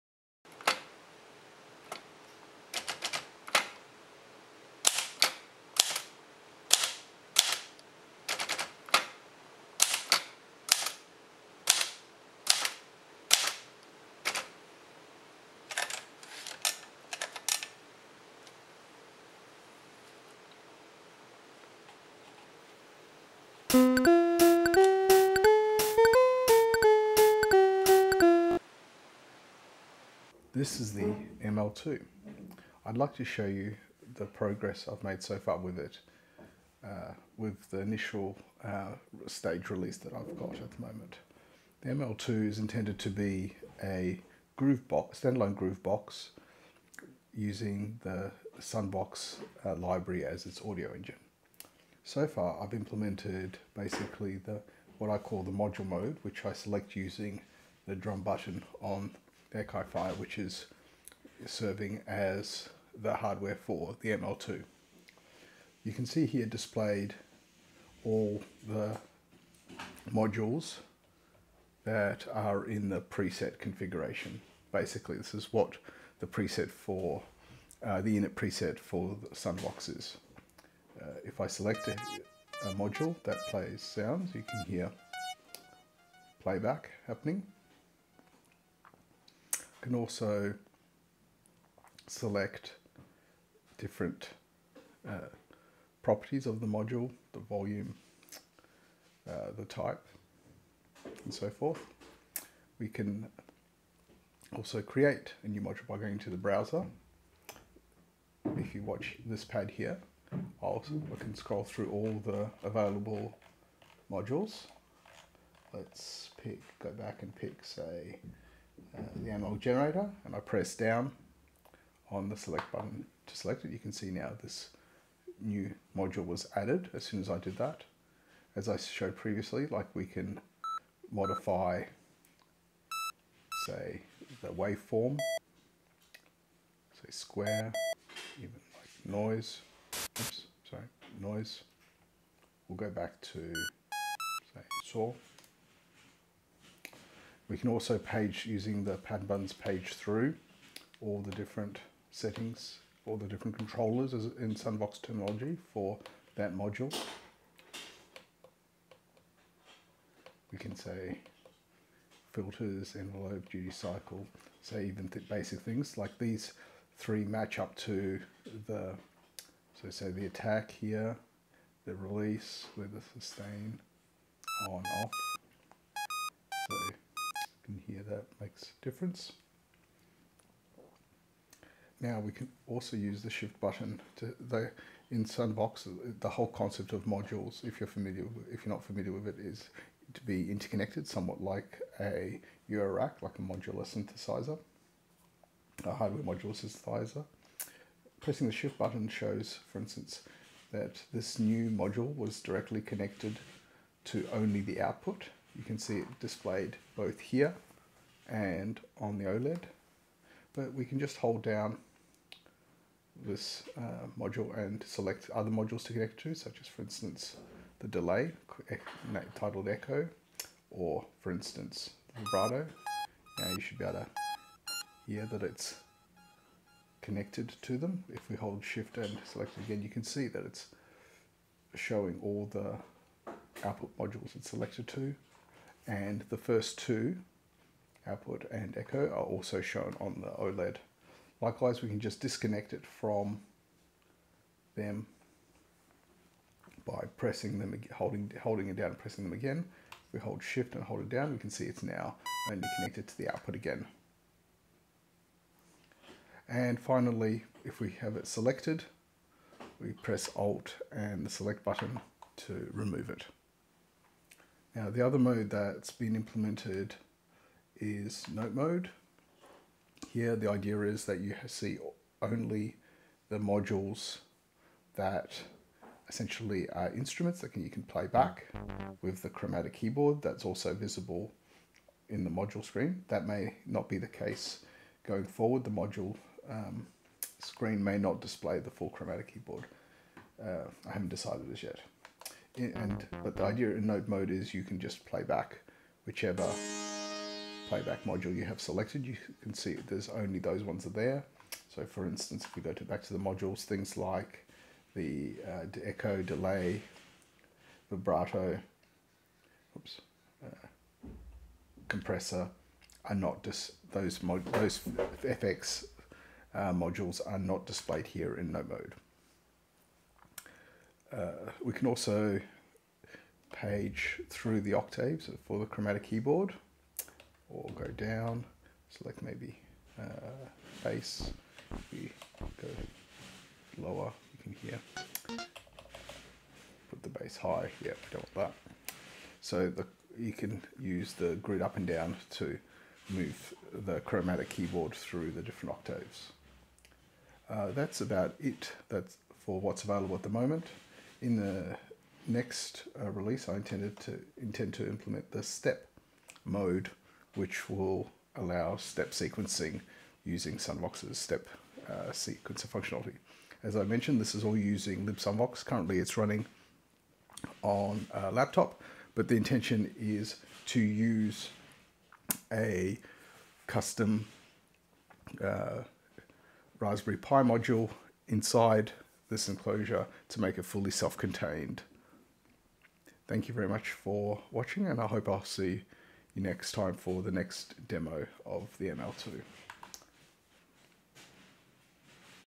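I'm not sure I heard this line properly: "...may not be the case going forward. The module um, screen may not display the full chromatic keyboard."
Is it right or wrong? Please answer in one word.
right.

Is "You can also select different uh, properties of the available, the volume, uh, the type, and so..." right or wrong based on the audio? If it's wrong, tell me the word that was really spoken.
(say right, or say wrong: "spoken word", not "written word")
wrong: "module", not "available".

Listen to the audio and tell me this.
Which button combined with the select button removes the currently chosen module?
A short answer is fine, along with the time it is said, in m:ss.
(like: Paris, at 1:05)
Alt, at 4:20.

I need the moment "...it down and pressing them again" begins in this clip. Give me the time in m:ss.
4:08.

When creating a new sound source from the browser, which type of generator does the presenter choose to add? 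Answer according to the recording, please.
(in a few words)
analog generator.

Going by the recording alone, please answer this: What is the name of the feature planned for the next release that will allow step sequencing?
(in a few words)
step mode.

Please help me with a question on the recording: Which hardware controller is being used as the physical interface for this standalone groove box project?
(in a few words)
Akai Fire.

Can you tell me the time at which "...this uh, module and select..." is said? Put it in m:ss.
3:33.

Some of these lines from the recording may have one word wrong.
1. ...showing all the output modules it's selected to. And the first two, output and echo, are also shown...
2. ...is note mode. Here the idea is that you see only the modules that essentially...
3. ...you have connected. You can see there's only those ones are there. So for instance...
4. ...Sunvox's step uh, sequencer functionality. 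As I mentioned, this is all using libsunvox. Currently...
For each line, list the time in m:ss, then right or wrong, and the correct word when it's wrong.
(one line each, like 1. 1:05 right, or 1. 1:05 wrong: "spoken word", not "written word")
1. 3:51 right
2. 4:27 right
3. 4:58 wrong: "selected", not "connected"
4. 6:00 right.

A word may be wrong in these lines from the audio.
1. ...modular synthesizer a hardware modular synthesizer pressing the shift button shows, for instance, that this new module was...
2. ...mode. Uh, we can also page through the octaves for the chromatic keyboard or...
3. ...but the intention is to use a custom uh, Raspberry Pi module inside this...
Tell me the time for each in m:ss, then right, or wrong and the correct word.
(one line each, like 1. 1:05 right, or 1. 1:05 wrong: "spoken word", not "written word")
1. 3:13 right
2. 5:18 right
3. 6:09 right.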